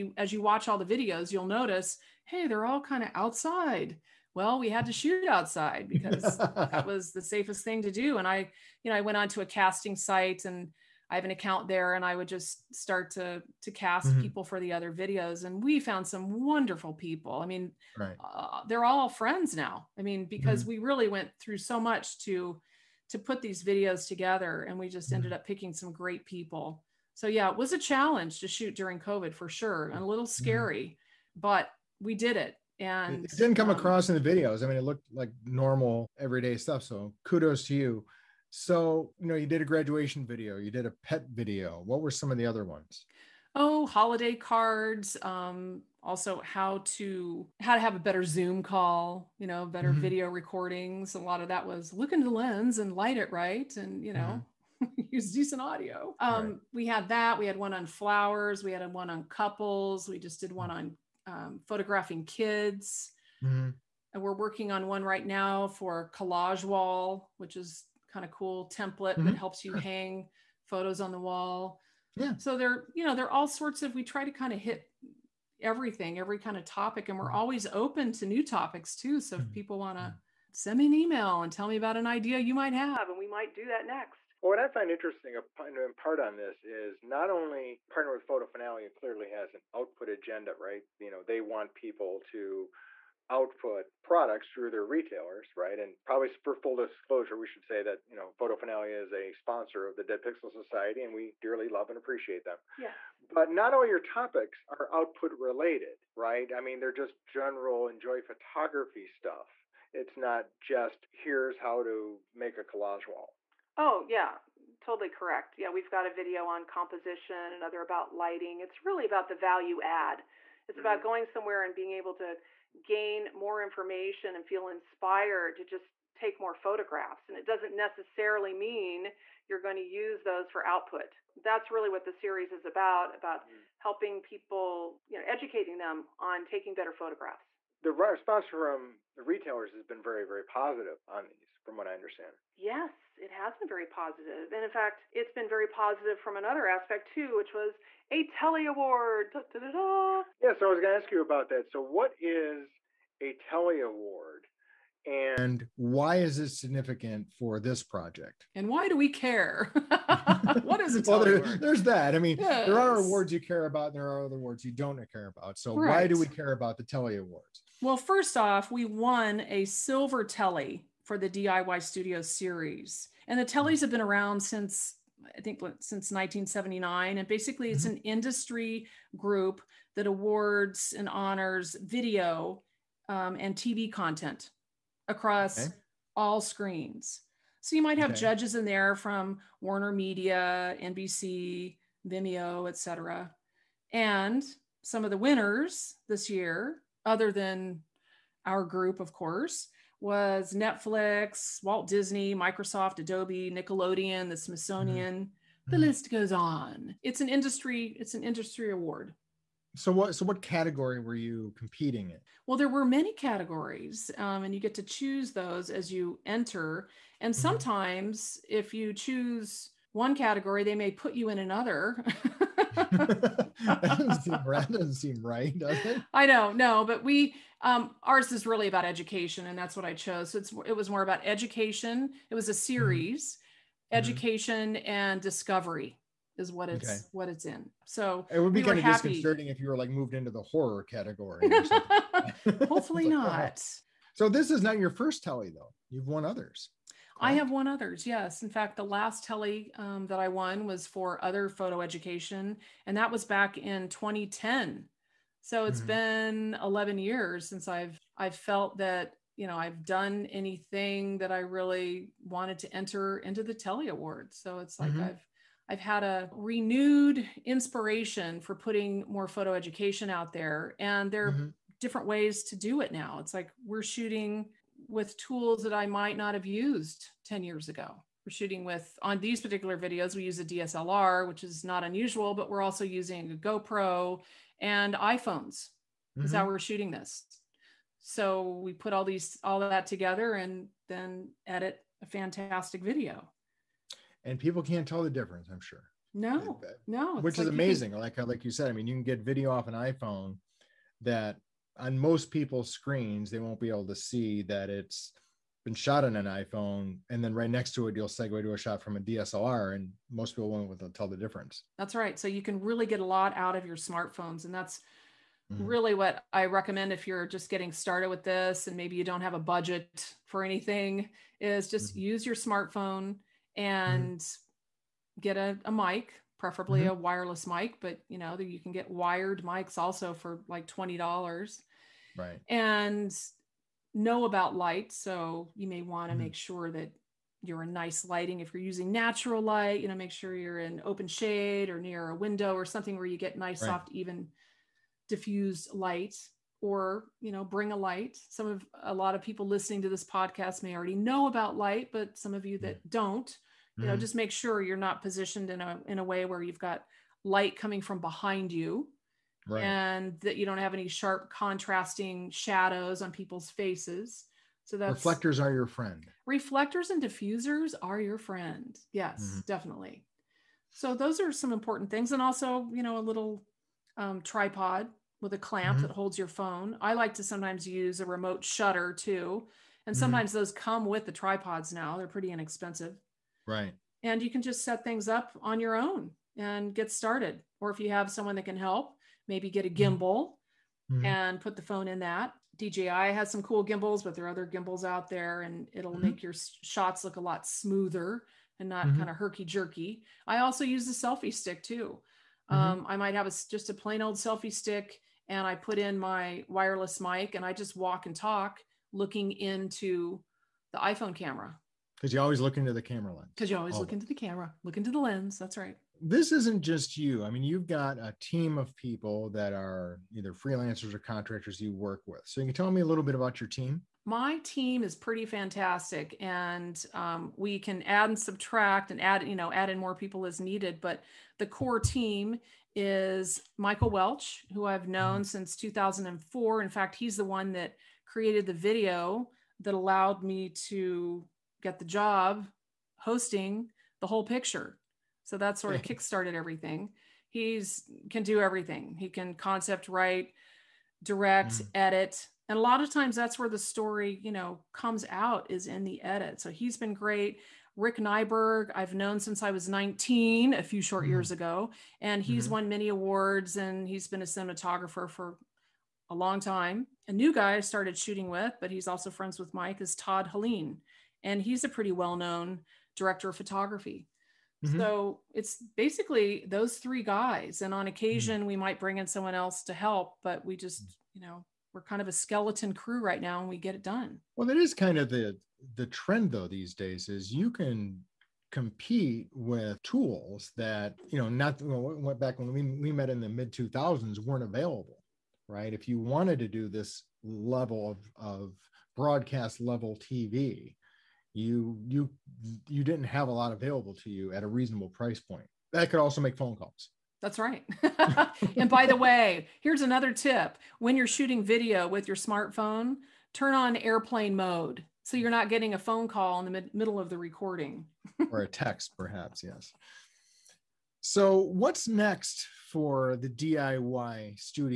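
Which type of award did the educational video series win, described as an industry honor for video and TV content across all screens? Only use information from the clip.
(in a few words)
Silver Telly.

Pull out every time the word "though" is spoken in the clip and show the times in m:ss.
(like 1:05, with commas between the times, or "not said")
4:05, 8:06.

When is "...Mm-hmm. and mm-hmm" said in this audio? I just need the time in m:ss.
5:23.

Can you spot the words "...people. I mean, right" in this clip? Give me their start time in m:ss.
0:16.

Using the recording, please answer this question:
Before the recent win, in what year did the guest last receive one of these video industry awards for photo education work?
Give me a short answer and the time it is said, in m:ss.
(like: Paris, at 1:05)
2010, at 4:13.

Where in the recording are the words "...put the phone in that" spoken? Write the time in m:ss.
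6:31.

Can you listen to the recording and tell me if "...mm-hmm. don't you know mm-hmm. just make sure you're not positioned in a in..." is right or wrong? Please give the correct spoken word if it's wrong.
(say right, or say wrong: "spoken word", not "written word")
right.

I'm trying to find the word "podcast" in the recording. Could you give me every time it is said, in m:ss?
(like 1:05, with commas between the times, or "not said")
5:50.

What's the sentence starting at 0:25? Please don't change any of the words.
ended up picking some great people.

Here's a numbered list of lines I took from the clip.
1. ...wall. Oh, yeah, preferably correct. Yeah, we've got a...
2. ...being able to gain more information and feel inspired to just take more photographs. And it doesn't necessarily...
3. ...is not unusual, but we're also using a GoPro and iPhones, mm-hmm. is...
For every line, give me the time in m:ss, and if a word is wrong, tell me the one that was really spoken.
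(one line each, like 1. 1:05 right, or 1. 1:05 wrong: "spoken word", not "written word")
1. 1:53 wrong: "totally", not "preferably"
2. 2:01 right
3. 4:41 right.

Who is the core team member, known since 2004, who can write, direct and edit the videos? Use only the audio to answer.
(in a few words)
Michael Welch.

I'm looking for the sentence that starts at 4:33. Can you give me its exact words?
It's like we're shooting with tools that I might not have used 10 years ago.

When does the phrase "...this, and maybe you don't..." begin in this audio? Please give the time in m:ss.
5:18.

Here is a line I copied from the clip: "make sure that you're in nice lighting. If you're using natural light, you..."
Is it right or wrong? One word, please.
right.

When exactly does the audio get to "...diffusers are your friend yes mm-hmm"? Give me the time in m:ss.
6:07.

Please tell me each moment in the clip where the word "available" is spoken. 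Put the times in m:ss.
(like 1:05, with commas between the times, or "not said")
8:14, 8:23.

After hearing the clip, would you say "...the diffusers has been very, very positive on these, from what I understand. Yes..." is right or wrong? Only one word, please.
wrong.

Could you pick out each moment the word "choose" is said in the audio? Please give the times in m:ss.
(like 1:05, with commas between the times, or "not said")
3:34, 3:38.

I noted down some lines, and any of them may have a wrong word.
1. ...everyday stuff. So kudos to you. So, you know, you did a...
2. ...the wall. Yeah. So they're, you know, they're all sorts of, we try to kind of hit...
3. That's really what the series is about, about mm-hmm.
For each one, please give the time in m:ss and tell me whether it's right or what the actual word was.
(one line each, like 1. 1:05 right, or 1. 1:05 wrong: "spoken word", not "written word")
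1. 0:36 right
2. 1:11 right
3. 2:11 right.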